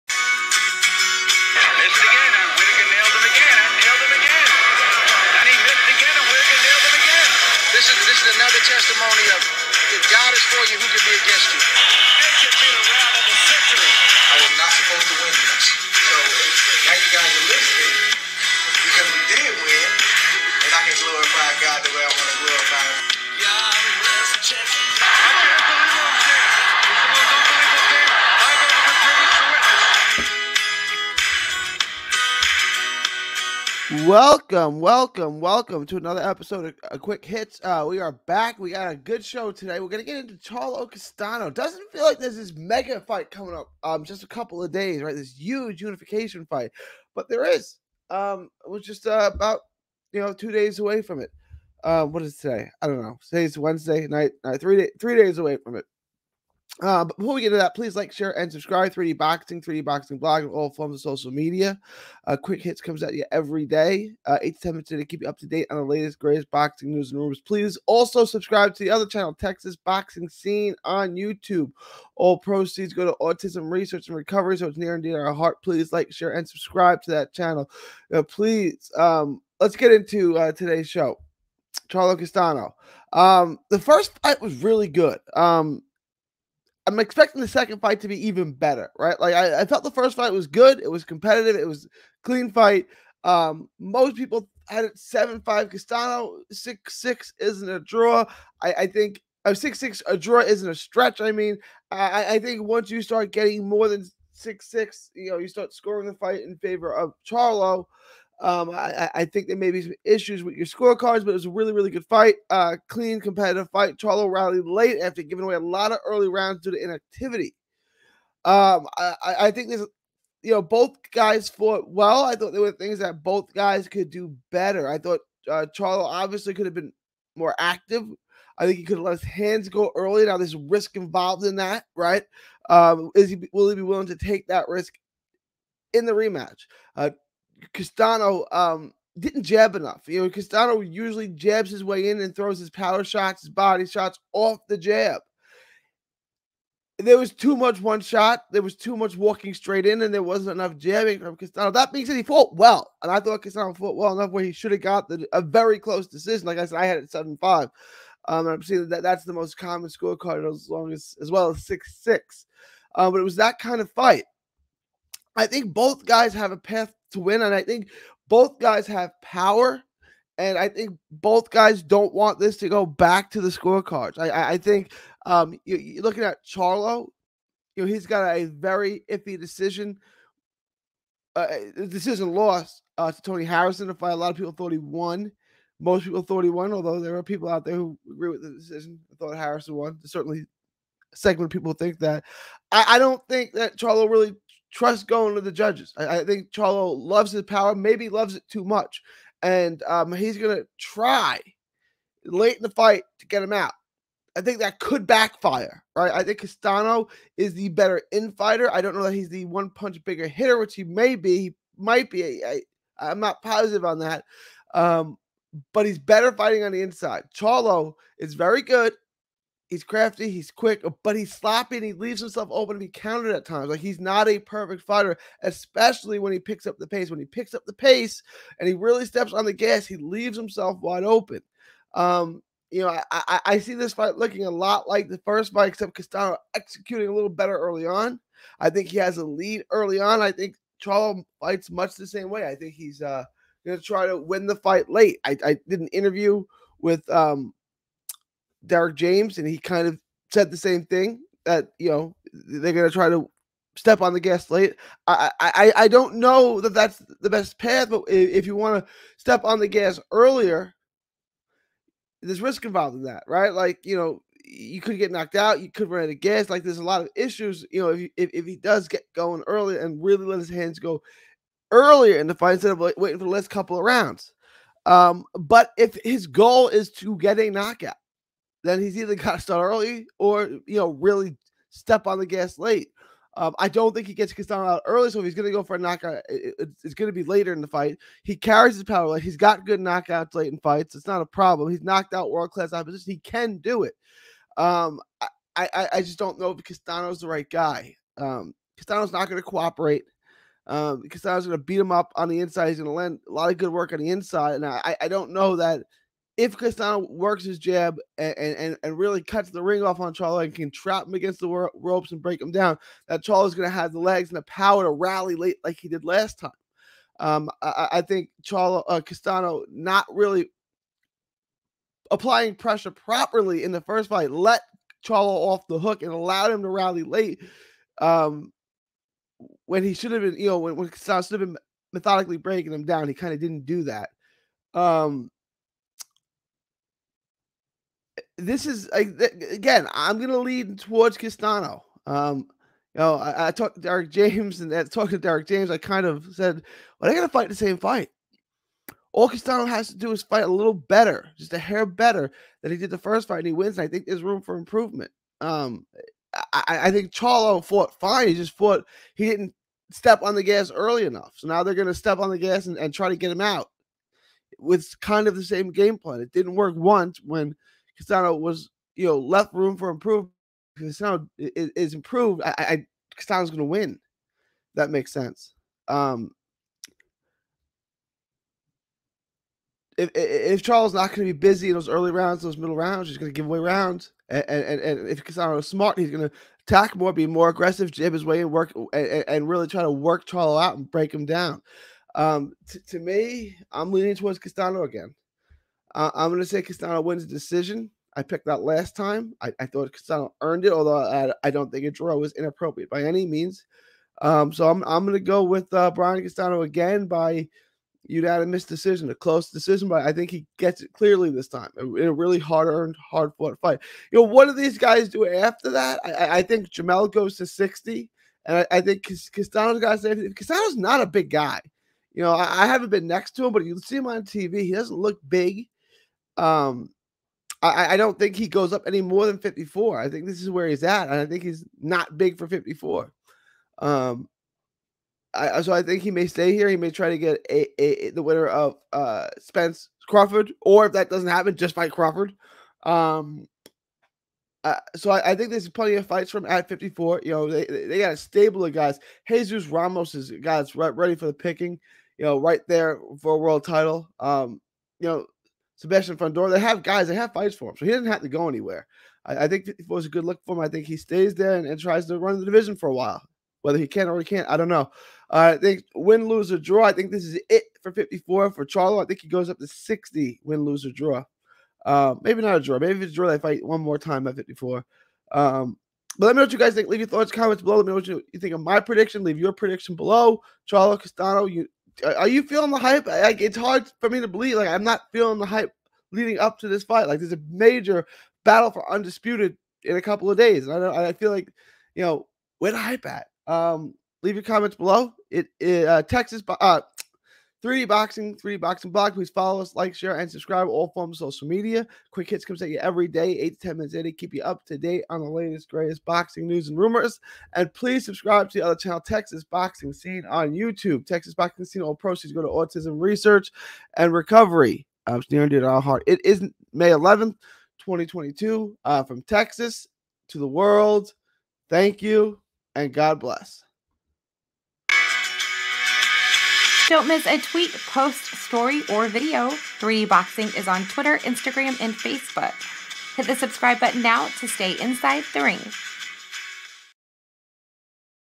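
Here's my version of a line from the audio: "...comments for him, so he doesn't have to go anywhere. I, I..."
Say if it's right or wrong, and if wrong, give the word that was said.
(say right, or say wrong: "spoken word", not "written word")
wrong: "fights", not "comments".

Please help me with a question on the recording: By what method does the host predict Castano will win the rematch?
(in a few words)
Unanimous decision.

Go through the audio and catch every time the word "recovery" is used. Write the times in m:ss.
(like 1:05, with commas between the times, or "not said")
1:14, 8:34.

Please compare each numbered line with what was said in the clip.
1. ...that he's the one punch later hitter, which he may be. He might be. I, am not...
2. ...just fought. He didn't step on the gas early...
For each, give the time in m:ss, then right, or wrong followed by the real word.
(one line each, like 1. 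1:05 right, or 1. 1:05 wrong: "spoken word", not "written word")
1. 3:29 wrong: "bigger", not "later"
2. 5:58 right.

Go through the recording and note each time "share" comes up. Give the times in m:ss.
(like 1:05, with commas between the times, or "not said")
0:58, 1:16, 8:19.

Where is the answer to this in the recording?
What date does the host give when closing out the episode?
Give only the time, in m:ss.
8:36.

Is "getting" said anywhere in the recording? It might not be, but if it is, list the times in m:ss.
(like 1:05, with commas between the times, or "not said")
1:43.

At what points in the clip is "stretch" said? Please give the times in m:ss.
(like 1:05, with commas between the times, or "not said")
1:40.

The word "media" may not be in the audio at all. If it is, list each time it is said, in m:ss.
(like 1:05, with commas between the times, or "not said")
1:01, 8:21.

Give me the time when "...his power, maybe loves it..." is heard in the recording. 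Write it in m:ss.
3:17.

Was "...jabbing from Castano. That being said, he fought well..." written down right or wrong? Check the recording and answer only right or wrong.
right.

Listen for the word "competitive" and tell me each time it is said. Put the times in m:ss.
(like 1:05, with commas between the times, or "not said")
1:31, 1:53.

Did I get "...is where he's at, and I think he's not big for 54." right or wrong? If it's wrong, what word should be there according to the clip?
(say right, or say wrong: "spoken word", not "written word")
right.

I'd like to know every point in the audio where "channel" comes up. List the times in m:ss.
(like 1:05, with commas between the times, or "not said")
1:09, 1:17, 8:28.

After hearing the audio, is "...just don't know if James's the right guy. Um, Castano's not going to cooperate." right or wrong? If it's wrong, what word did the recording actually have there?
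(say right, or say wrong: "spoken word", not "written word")
wrong: "Castano", not "James".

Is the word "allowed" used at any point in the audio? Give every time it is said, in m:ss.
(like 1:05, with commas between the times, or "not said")
5:26.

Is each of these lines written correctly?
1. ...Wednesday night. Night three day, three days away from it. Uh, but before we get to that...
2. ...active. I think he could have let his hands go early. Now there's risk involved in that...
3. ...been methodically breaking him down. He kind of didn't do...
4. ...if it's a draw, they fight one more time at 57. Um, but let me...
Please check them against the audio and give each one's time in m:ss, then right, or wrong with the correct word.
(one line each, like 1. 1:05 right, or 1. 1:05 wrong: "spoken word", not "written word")
1. 0:53 right
2. 2:07 right
3. 5:31 right
4. 7:52 wrong: "54", not "57".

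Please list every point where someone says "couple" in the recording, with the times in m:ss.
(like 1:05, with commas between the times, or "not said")
0:44, 4:33, 8:10.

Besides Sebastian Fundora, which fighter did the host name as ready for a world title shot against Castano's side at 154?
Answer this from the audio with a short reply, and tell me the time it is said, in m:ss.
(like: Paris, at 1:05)
Jesus Ramos, at 7:29.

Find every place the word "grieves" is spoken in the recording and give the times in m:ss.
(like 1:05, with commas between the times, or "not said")
not said.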